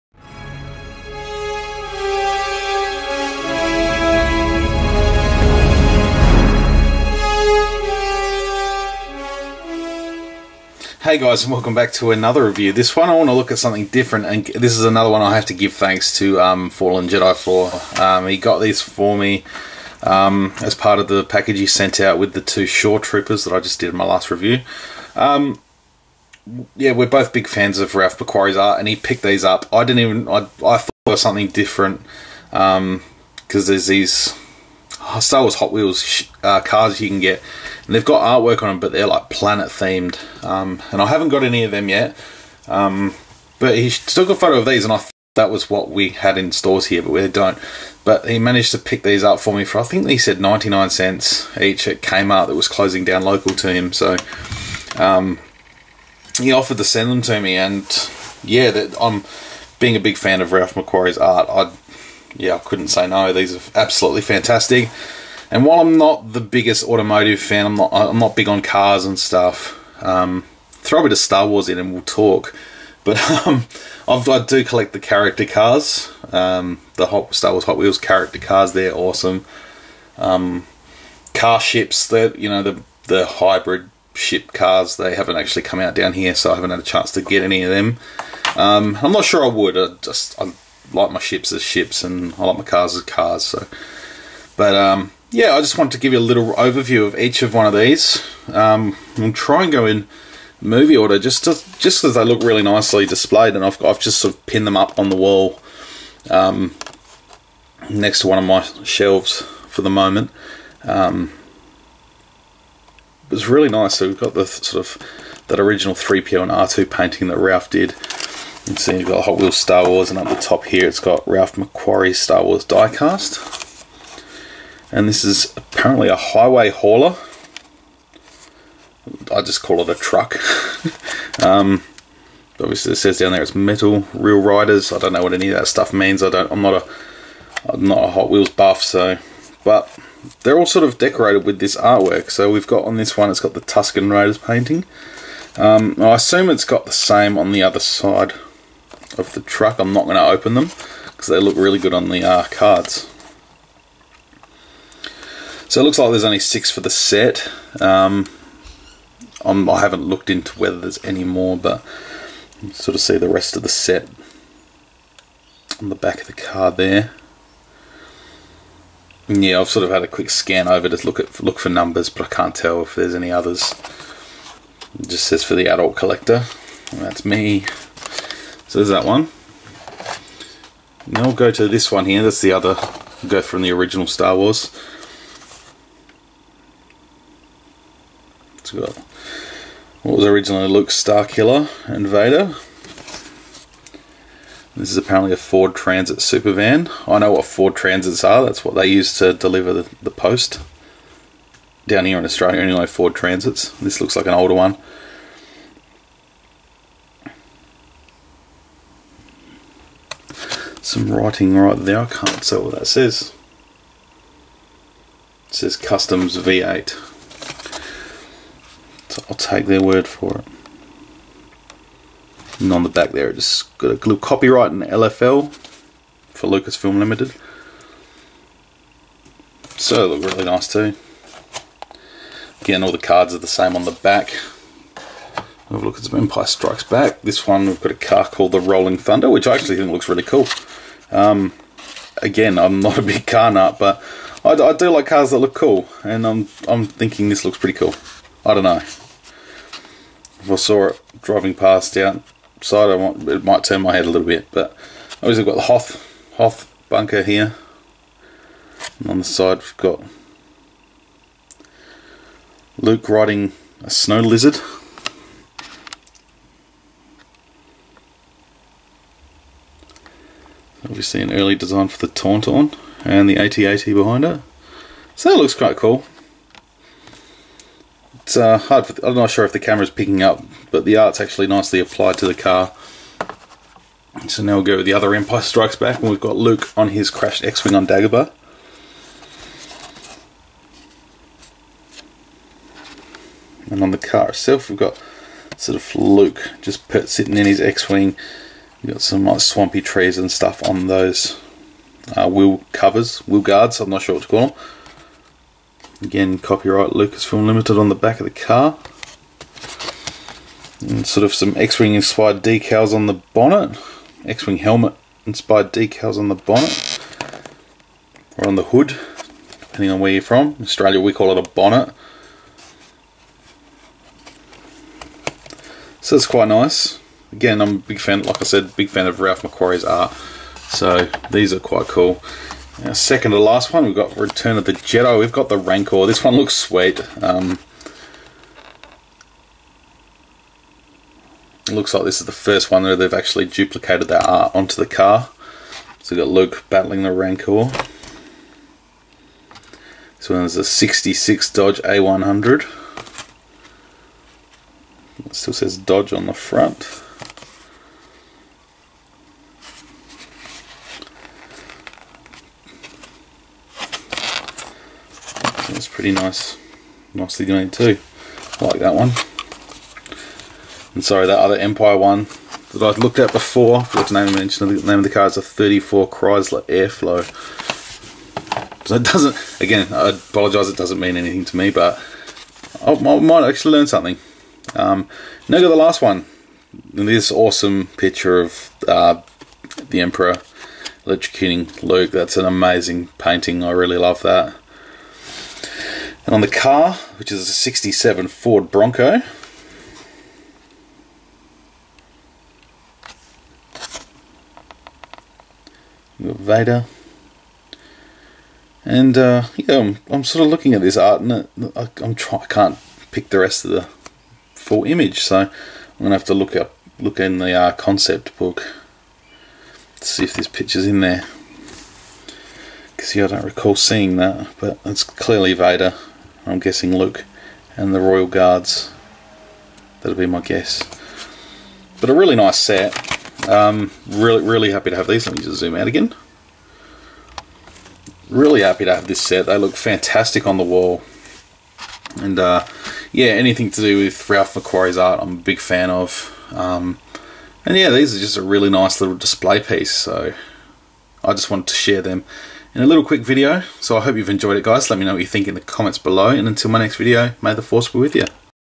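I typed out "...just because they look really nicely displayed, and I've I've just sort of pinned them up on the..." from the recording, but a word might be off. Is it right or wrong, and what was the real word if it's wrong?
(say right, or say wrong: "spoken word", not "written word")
right.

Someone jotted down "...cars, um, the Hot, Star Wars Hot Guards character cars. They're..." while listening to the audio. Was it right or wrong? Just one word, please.
wrong.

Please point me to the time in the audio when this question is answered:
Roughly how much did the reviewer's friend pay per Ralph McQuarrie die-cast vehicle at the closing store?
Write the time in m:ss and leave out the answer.
0:50.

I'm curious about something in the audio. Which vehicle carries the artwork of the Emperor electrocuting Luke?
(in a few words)
67 Ford Bronco.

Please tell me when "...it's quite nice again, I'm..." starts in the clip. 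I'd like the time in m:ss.
5:26.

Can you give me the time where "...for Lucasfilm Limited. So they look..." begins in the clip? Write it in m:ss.
3:46.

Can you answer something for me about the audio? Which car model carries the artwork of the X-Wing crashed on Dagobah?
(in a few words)
34 Chrysler Airflow.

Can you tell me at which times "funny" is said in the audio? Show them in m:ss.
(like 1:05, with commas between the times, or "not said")
not said.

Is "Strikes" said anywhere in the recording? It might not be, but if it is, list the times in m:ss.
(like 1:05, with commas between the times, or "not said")
3:56, 4:45.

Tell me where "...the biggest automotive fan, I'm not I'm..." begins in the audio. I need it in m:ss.
1:06.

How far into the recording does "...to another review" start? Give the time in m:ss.
0:11.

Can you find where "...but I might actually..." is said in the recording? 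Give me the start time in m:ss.
6:21.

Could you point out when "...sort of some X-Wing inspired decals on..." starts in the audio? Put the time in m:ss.
5:11.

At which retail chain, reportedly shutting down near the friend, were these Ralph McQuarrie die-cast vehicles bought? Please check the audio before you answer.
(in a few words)
Kmart.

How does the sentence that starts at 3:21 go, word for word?
Down here in Australia, only Ford Transits.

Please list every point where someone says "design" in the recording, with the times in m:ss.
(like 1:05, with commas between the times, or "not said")
4:31.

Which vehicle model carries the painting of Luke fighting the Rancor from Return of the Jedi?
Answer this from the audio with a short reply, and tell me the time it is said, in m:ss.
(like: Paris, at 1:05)
66 Dodge A100, at 5:50.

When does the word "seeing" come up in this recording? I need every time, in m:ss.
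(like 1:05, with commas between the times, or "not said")
7:03.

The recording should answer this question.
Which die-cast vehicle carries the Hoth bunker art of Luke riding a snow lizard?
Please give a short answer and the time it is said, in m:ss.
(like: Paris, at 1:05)
Rolling Thunder, at 3:58.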